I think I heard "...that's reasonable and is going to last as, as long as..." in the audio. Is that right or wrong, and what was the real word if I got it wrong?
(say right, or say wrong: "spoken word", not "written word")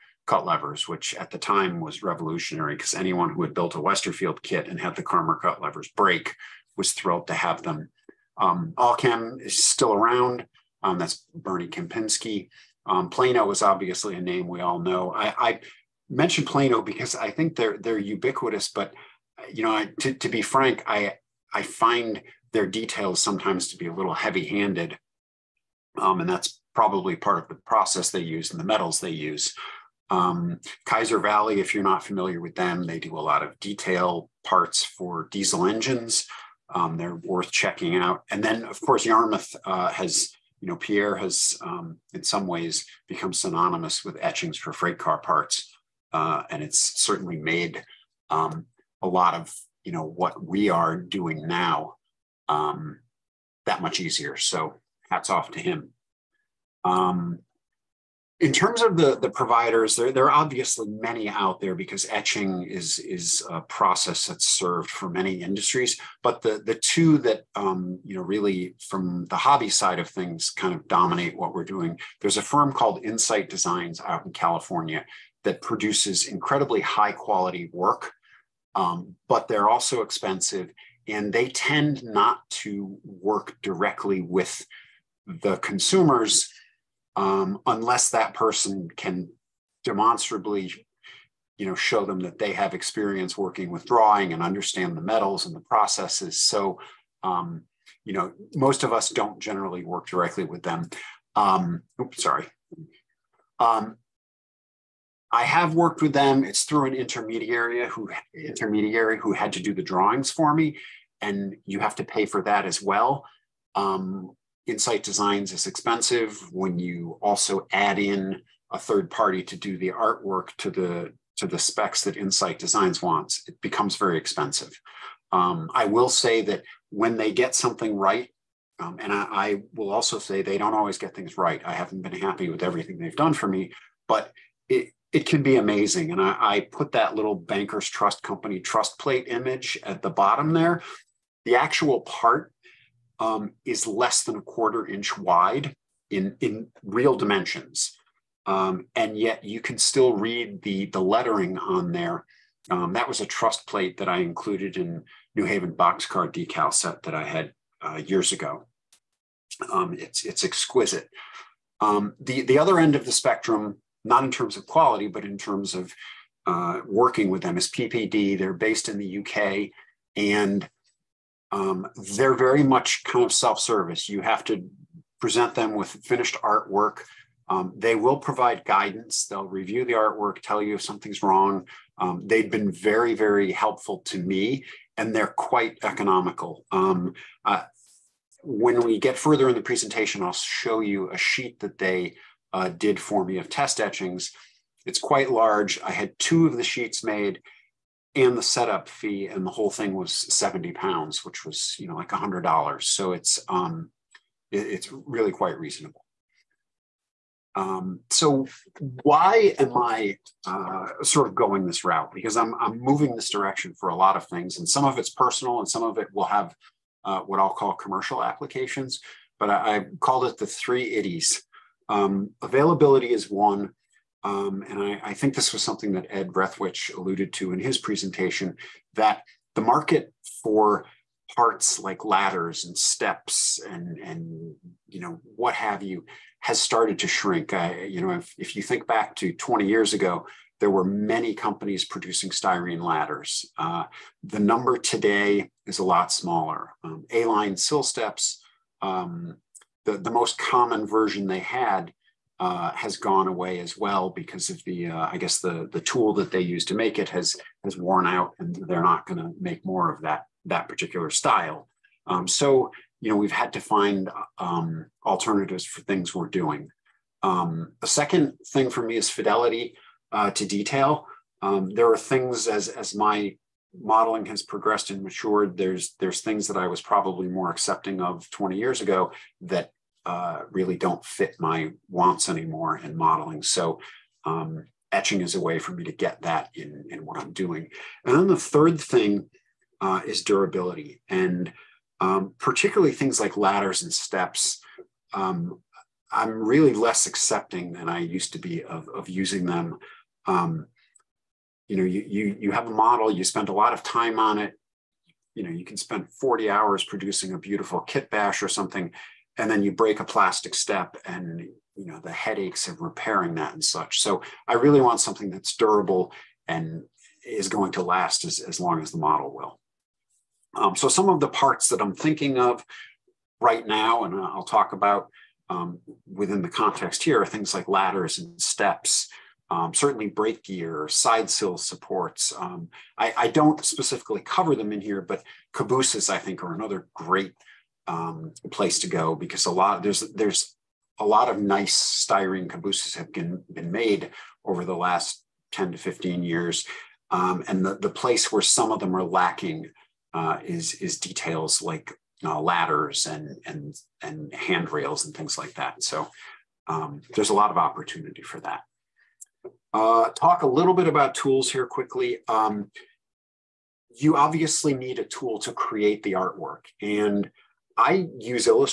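wrong: "durable", not "reasonable".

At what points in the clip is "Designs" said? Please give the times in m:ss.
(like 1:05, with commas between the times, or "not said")
1:13, 1:55, 2:02.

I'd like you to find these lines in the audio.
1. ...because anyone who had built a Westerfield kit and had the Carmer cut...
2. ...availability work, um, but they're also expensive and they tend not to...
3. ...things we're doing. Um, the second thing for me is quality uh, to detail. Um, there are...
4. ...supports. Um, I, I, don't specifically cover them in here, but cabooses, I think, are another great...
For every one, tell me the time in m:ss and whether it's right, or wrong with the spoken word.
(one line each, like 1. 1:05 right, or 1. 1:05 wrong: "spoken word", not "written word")
1. 0:02 right
2. 1:17 wrong: "quality", not "availability"
3. 4:25 wrong: "fidelity", not "quality"
4. 5:31 right.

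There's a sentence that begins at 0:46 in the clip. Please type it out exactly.
Uh, and it's certainly made um, a lot of, you know, what we are doing now um, that much easier.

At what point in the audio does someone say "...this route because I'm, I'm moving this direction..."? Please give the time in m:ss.
3:31.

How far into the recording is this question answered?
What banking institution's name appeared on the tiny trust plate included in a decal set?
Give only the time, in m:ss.
2:17.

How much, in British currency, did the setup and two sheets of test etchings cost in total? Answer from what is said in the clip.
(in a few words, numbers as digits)
70 pounds.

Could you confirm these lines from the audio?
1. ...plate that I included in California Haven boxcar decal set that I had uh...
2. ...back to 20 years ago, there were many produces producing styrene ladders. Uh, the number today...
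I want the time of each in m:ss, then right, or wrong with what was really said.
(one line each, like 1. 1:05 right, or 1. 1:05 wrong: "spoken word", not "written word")
1. 2:33 wrong: "New", not "California"
2. 3:58 wrong: "companies", not "produces".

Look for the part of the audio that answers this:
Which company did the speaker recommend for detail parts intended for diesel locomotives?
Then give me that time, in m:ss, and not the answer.
0:30.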